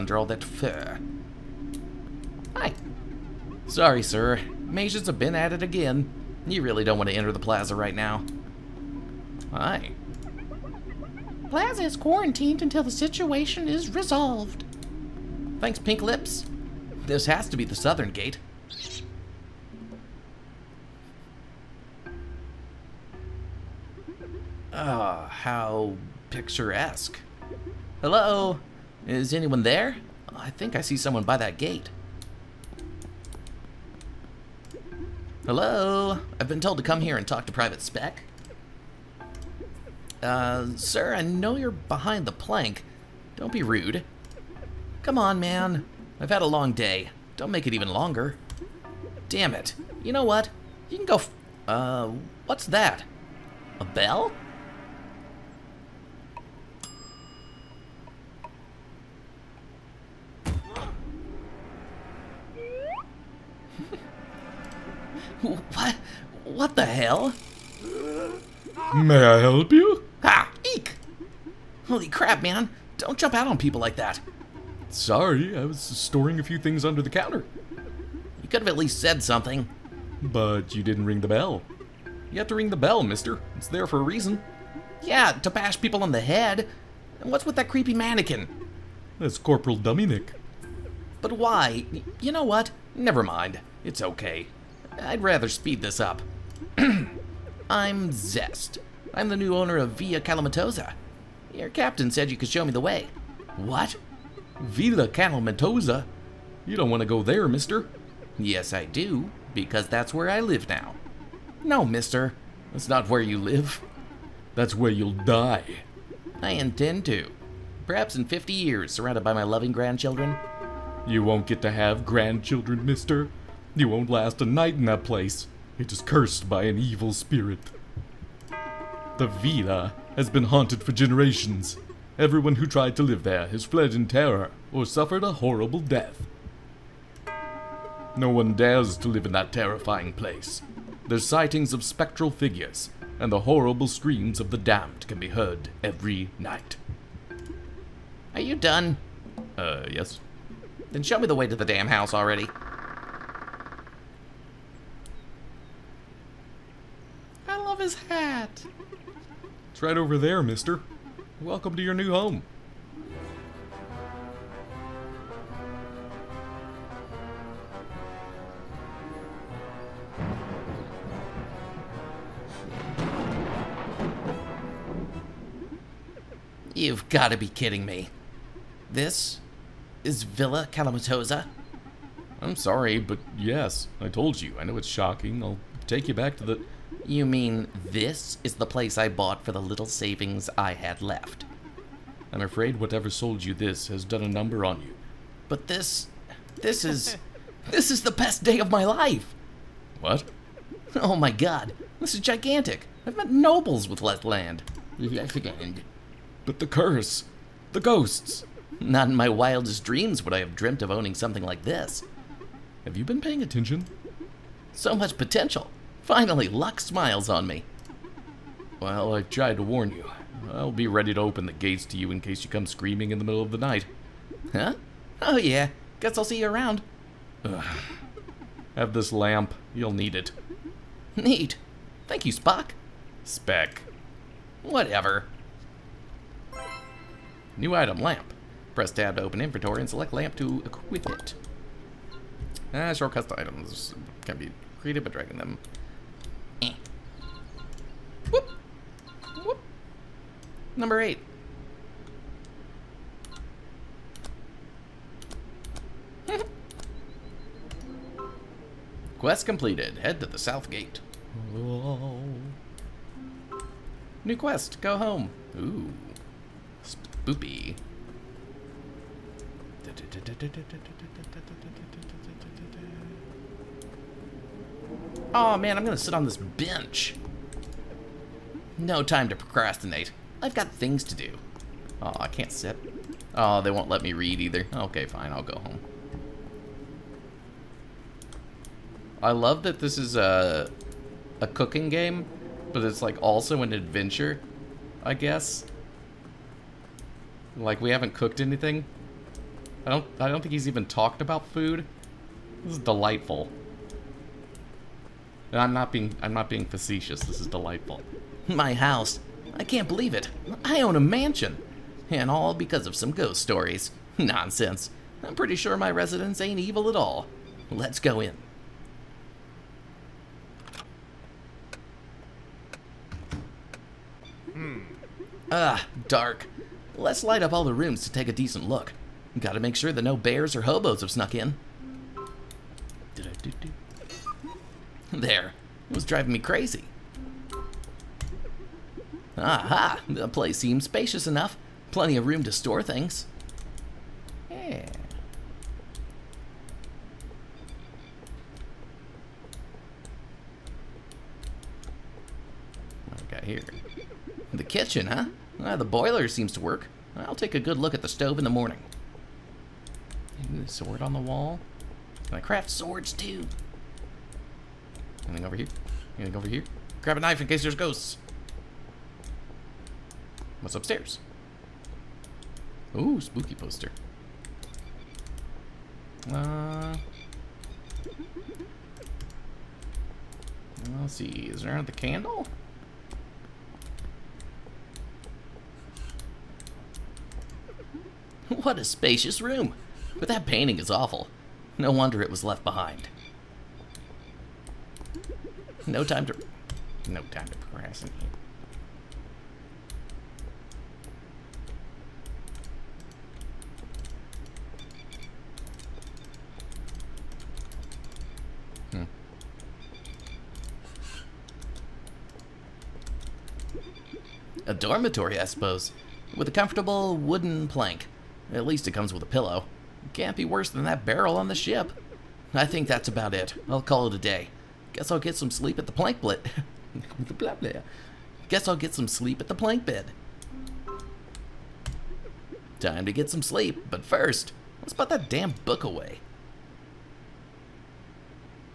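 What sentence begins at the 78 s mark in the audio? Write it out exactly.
You could have at least said something.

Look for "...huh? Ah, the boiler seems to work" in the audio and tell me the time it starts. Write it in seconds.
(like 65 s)
355 s.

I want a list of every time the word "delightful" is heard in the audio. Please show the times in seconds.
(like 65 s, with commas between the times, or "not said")
302 s, 307 s.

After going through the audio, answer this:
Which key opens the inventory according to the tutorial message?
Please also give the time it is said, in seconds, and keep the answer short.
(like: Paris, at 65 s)
tab, at 238 s.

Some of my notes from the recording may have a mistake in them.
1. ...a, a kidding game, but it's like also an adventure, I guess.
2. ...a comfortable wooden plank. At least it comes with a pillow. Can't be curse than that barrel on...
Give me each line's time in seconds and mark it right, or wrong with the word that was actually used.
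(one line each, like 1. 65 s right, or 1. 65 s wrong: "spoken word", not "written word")
1. 290 s wrong: "cooking", not "kidding"
2. 416 s wrong: "worse", not "curse".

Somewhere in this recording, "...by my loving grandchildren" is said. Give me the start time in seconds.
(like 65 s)
119 s.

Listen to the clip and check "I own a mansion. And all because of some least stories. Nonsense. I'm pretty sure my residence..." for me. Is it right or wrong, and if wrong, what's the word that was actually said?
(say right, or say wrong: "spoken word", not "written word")
wrong: "ghost", not "least".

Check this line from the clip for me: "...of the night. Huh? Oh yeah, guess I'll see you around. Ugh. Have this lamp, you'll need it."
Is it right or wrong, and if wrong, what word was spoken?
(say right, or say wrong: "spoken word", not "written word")
right.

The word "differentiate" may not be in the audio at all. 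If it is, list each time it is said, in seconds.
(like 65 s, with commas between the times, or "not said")
not said.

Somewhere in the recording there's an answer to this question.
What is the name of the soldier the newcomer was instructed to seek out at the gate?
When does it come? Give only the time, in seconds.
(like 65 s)
37 s.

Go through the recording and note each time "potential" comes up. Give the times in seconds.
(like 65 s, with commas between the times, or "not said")
215 s.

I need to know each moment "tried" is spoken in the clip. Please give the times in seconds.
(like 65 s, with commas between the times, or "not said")
132 s, 219 s.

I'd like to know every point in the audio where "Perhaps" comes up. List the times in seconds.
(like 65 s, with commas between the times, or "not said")
117 s.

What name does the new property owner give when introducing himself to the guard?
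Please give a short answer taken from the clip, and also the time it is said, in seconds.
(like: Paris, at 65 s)
Zest, at 98 s.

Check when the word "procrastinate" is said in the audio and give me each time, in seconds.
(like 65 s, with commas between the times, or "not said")
279 s, 397 s.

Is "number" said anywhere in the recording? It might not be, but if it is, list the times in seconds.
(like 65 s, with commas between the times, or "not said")
194 s, 250 s.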